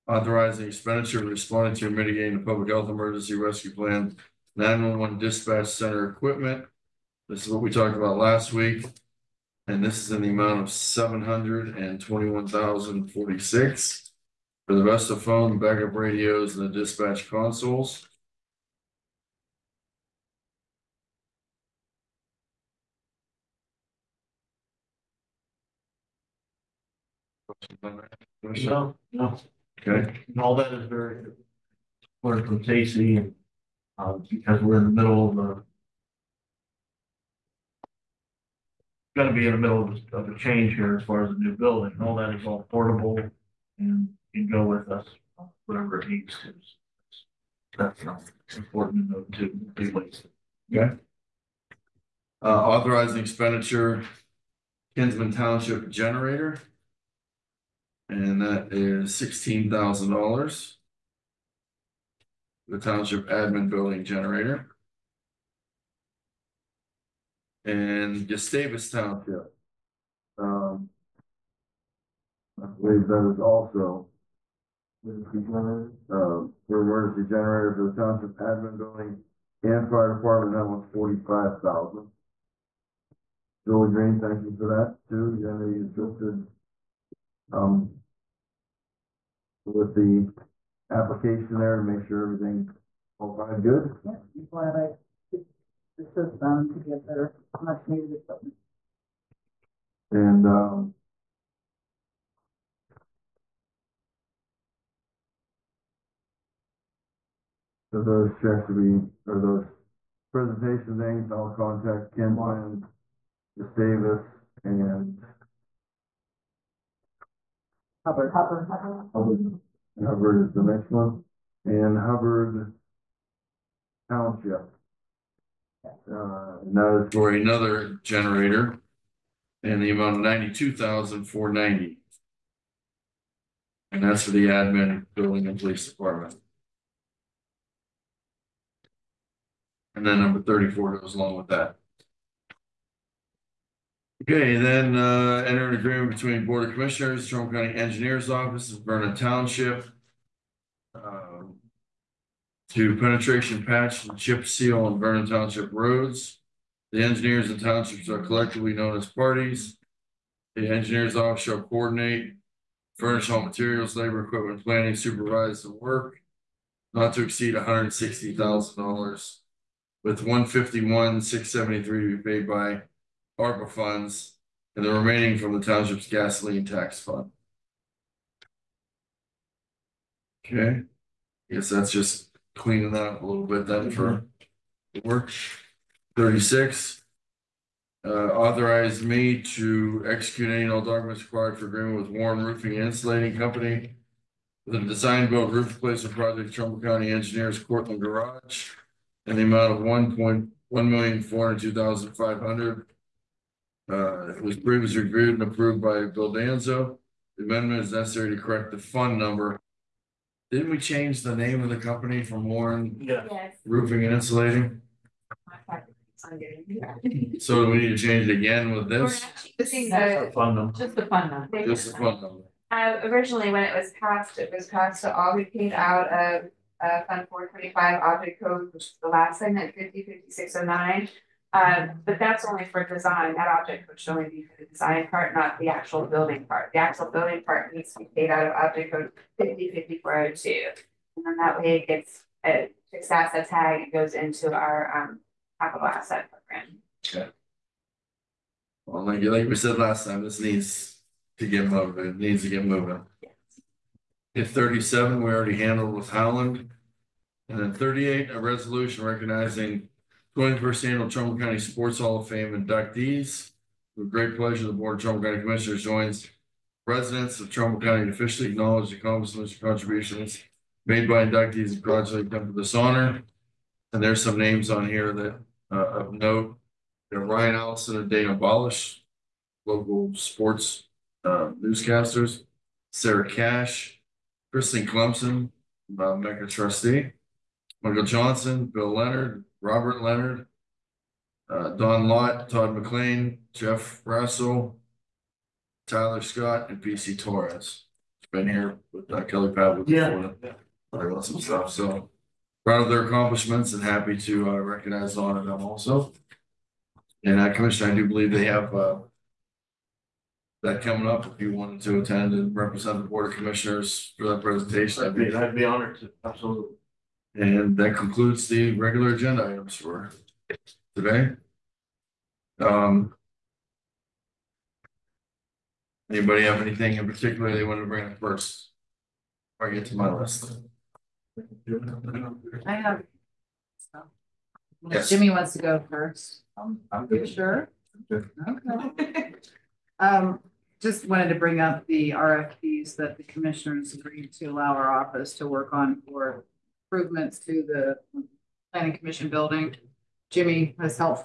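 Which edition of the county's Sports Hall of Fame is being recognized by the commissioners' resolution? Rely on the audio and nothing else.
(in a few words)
21st.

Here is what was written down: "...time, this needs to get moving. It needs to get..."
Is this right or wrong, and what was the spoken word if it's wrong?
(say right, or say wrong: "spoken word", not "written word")
right.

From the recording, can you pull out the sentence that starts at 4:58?
Been here with uh, Kelly Pavlik.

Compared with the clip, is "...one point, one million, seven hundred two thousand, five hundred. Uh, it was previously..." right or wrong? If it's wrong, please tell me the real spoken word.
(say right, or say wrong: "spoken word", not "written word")
wrong: "four", not "seven".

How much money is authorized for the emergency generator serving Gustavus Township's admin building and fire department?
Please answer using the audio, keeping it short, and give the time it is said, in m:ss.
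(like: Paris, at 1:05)
$45,000, at 1:20.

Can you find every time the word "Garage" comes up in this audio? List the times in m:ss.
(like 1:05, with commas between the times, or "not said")
3:18.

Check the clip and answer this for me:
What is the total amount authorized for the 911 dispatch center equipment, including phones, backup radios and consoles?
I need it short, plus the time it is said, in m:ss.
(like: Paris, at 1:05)
$721,046, at 0:10.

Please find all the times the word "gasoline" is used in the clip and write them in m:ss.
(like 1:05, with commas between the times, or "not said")
2:56.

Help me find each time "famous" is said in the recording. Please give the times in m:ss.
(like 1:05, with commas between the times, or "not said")
not said.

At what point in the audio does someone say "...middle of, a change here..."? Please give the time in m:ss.
0:39.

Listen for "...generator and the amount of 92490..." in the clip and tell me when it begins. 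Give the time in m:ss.
2:08.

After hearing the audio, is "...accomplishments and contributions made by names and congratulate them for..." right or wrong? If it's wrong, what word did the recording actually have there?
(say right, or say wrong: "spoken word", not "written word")
wrong: "inductees", not "names".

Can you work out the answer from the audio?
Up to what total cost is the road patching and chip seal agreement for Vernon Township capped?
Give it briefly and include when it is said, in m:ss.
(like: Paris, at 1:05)
$160,000, at 2:47.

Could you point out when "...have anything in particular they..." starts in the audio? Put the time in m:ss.
5:26.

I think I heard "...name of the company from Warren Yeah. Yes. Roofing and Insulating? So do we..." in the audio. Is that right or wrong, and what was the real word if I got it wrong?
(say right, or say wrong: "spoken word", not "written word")
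right.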